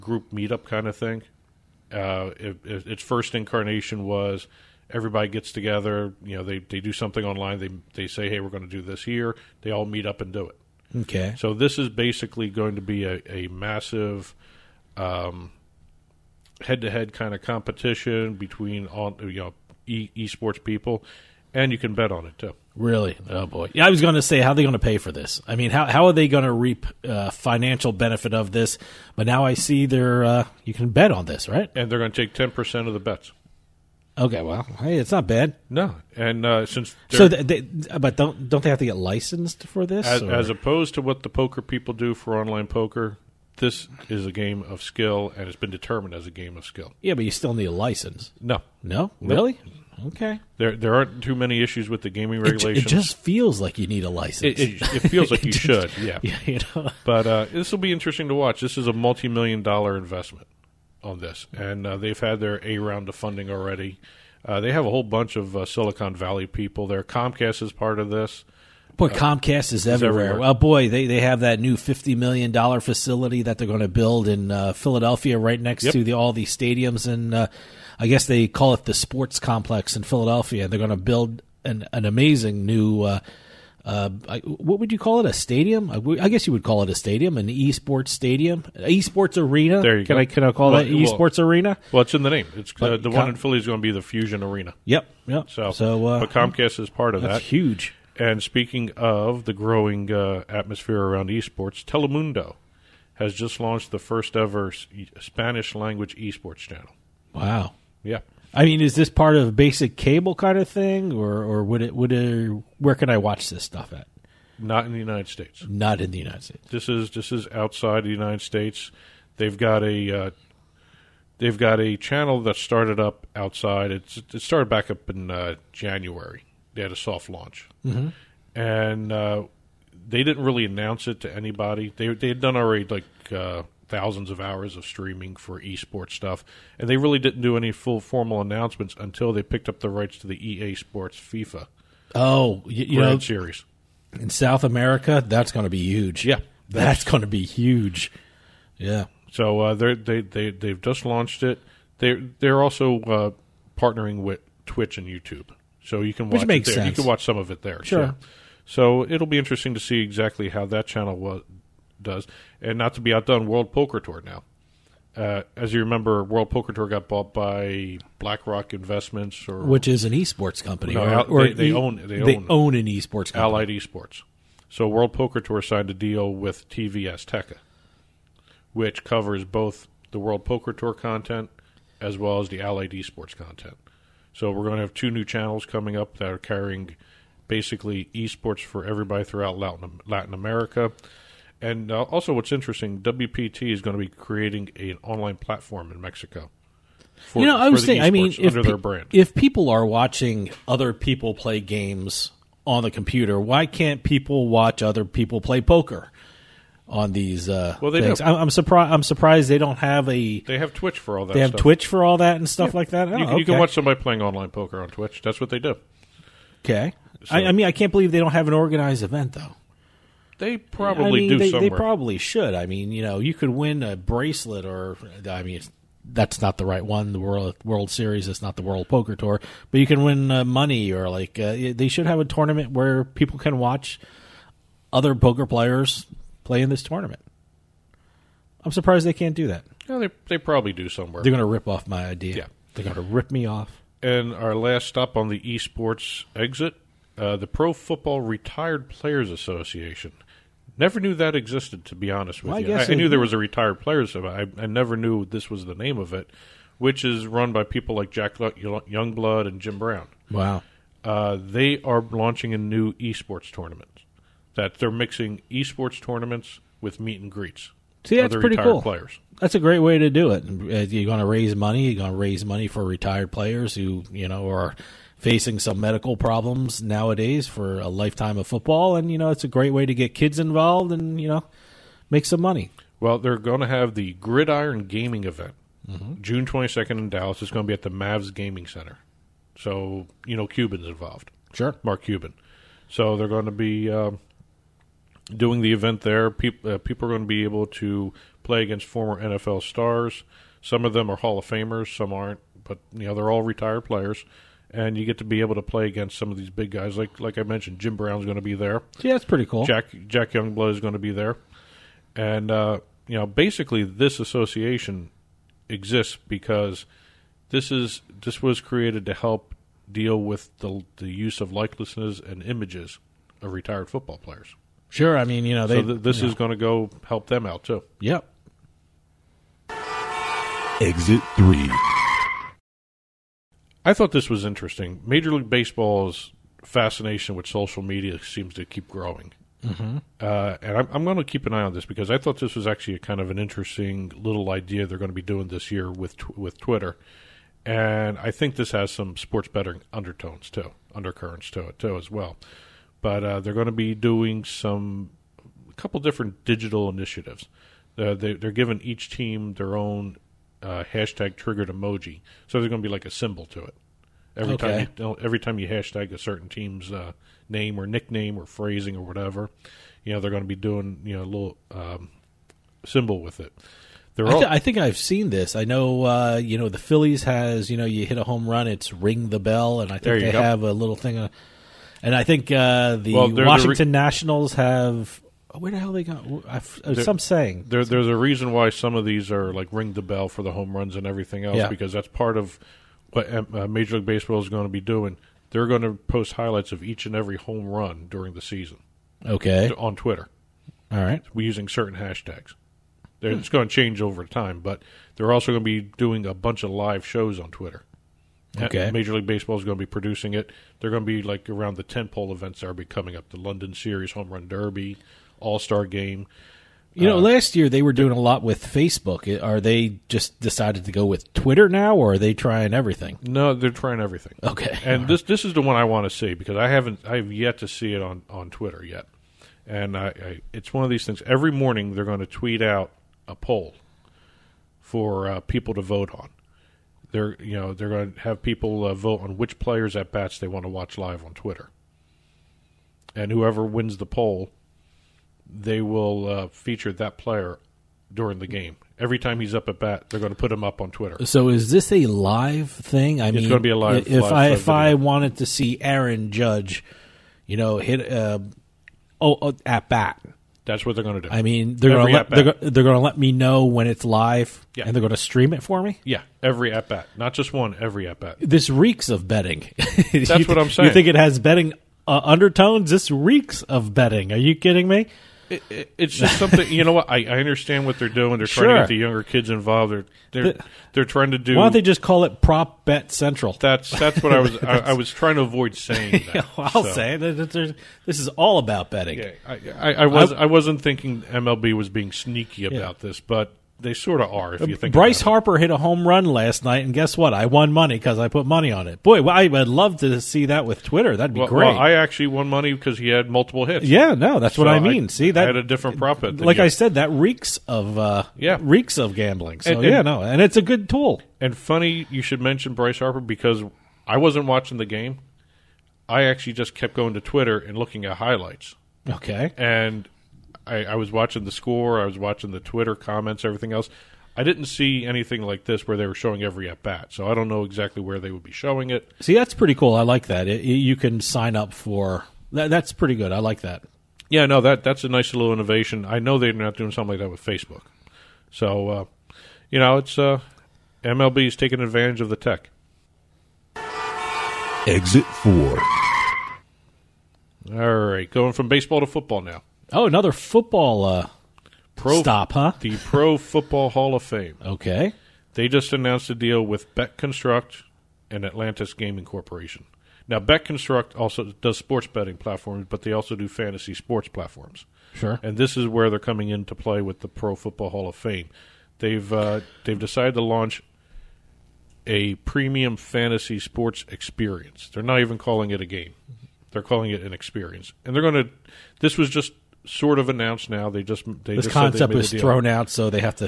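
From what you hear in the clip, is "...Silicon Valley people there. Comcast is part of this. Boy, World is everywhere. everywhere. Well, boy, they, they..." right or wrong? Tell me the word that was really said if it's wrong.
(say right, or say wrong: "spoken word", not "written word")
wrong: "Comcast", not "World".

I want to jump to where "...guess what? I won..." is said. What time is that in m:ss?
8:16.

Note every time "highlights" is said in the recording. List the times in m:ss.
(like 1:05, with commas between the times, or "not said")
6:36, 8:38.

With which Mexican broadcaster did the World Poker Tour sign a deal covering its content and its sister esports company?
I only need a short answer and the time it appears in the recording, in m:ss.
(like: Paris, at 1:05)
TV Azteca, at 2:56.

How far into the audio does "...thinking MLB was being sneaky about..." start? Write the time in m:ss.
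8:10.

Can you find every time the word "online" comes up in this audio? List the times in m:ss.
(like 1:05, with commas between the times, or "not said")
0:07, 0:42, 3:15, 3:34.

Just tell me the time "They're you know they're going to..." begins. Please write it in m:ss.
7:17.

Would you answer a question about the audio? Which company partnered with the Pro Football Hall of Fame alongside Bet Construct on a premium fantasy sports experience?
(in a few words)
Atlantis Gaming Corporation.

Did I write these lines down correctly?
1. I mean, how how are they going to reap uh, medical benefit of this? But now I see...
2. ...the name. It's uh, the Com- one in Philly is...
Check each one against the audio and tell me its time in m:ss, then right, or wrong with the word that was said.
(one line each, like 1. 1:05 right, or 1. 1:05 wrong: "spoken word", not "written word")
1. 0:25 wrong: "financial", not "medical"
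2. 1:32 right.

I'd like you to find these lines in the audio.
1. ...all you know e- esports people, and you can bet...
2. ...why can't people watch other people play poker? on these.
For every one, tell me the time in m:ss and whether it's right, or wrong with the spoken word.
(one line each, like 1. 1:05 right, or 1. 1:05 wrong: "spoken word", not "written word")
1. 0:18 right
2. 3:23 right.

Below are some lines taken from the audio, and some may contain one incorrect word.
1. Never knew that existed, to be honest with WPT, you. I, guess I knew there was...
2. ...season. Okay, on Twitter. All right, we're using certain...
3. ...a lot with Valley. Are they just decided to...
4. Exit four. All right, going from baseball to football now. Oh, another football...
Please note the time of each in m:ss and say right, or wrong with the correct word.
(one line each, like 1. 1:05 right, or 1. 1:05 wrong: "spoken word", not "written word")
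1. 4:10 wrong: "Well", not "WPT"
2. 6:38 right
3. 6:58 wrong: "Facebook", not "Valley"
4. 9:04 right.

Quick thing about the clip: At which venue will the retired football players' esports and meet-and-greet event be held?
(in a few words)
Mavs Gaming Center.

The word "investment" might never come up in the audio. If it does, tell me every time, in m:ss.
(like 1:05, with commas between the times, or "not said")
0:59, 2:48.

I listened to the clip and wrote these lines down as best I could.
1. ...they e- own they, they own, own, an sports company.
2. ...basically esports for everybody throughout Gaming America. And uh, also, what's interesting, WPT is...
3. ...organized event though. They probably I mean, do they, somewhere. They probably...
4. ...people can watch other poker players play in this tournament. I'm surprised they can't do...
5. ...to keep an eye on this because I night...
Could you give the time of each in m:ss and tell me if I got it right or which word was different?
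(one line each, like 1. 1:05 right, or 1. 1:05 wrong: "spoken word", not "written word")
1. 2:51 wrong: "esports", not "sports"
2. 3:07 wrong: "Latin", not "Gaming"
3. 3:38 right
4. 3:53 right
5. 5:41 wrong: "thought", not "night".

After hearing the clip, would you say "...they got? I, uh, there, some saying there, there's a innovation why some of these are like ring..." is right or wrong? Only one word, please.
wrong.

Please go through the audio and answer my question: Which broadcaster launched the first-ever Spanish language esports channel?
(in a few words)
Telemundo.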